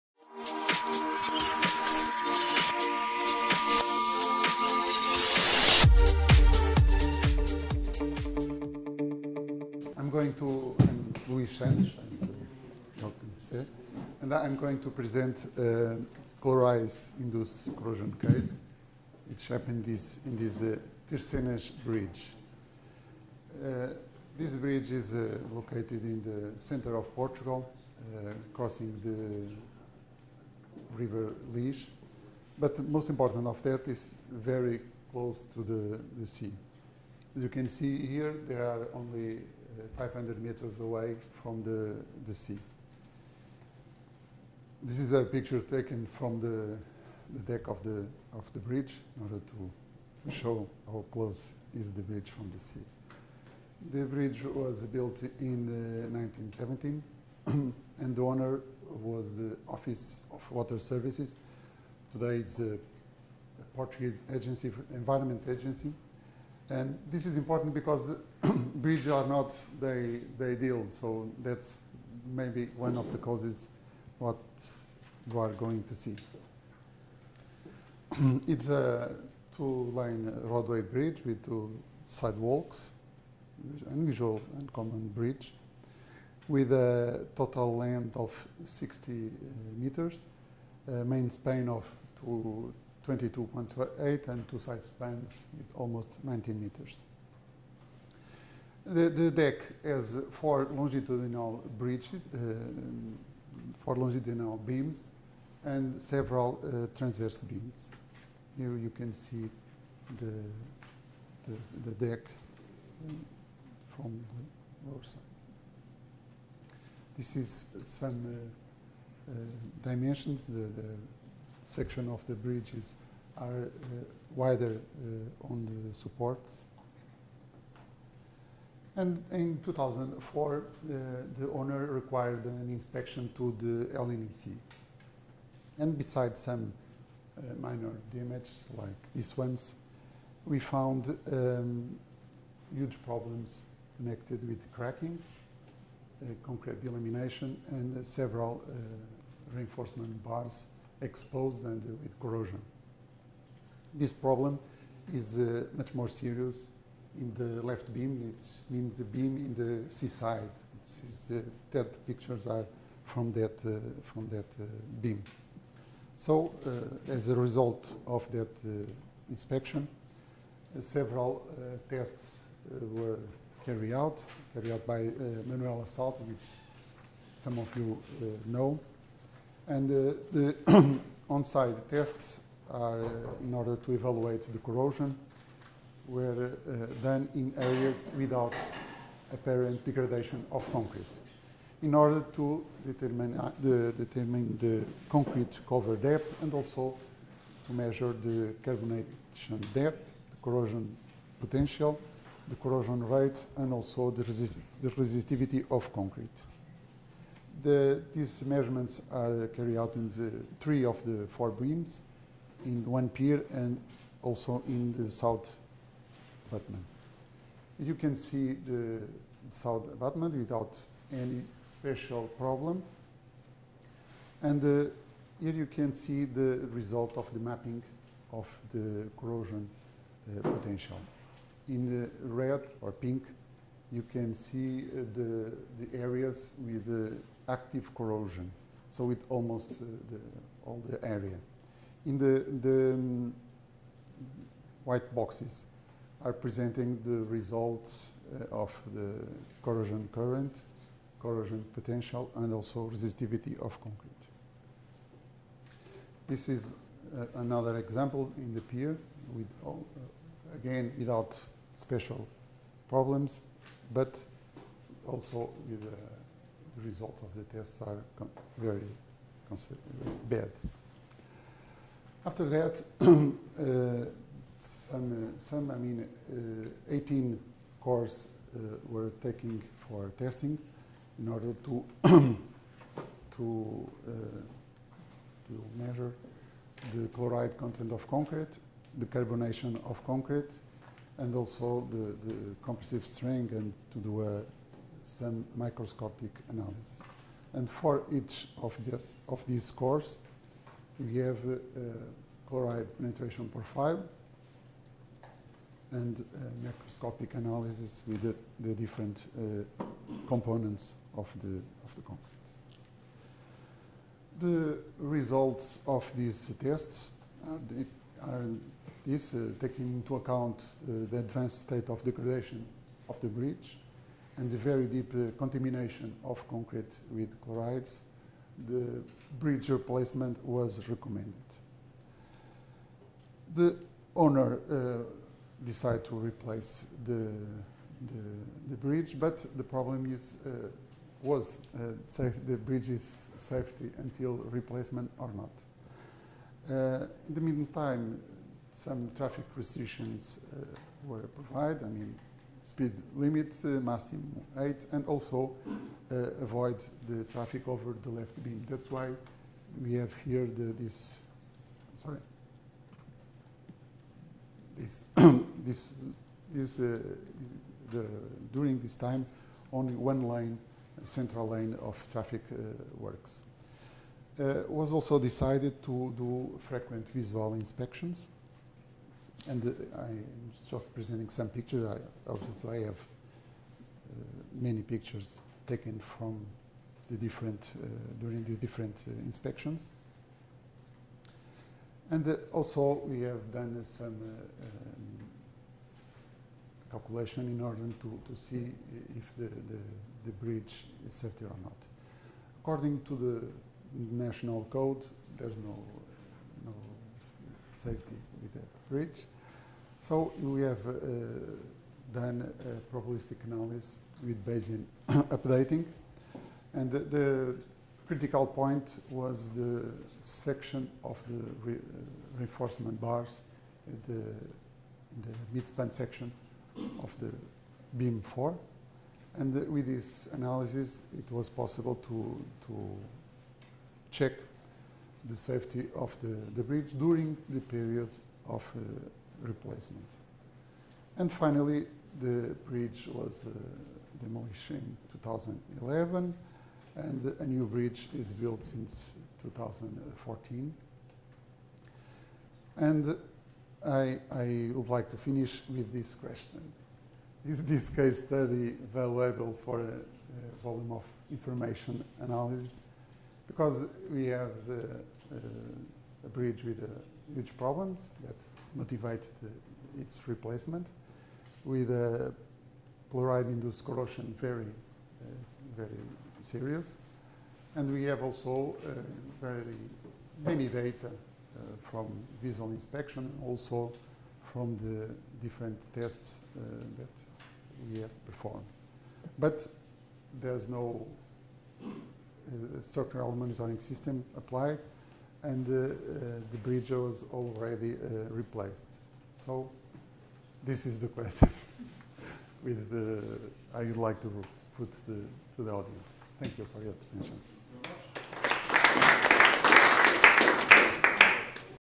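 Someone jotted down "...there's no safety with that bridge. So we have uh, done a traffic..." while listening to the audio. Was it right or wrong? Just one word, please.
wrong.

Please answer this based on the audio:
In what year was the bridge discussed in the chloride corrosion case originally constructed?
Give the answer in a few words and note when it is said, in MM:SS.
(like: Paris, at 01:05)
1917, at 00:56.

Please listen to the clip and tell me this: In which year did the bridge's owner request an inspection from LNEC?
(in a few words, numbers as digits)
2004.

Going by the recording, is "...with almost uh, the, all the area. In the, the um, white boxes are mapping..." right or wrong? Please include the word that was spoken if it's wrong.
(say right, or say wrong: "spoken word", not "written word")
wrong: "presenting", not "mapping".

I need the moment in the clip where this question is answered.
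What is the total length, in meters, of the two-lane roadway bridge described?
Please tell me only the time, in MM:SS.
01:28.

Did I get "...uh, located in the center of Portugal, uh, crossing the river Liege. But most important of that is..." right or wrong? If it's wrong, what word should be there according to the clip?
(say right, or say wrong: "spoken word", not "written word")
right.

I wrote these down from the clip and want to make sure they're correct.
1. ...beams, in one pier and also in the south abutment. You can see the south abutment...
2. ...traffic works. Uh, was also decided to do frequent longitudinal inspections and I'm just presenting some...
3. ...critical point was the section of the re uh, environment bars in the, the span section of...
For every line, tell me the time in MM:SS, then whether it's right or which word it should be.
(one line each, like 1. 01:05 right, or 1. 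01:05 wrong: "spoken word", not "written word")
1. 03:31 right
2. 06:12 wrong: "visual", not "longitudinal"
3. 06:58 wrong: "reinforcement", not "environment".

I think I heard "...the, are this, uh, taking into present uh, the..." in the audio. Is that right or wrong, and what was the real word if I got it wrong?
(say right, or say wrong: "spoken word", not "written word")
wrong: "account", not "present".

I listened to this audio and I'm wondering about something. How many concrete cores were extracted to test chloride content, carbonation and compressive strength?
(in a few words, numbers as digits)
18.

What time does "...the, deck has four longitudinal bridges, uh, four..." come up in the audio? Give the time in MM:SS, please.
01:39.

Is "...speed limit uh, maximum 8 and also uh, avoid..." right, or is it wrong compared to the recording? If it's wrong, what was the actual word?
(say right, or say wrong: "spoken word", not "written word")
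right.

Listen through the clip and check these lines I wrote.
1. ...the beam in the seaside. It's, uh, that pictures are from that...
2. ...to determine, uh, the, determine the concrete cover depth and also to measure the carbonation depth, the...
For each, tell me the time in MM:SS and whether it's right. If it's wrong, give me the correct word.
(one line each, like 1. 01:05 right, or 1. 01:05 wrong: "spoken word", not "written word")
1. 02:38 right
2. 03:12 right.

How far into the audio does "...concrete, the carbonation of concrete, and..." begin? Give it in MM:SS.
04:48.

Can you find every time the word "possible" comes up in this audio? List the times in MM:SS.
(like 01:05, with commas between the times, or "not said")
07:11.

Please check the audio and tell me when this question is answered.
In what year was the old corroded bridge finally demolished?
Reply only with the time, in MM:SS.
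07:25.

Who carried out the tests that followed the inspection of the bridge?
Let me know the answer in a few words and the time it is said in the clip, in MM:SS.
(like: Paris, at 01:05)
Manuel Salta, at 02:55.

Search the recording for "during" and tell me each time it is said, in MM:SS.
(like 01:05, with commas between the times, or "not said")
06:08, 06:28, 07:16.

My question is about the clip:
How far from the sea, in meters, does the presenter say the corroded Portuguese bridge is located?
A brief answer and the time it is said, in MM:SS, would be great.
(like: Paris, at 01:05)
500, at 00:39.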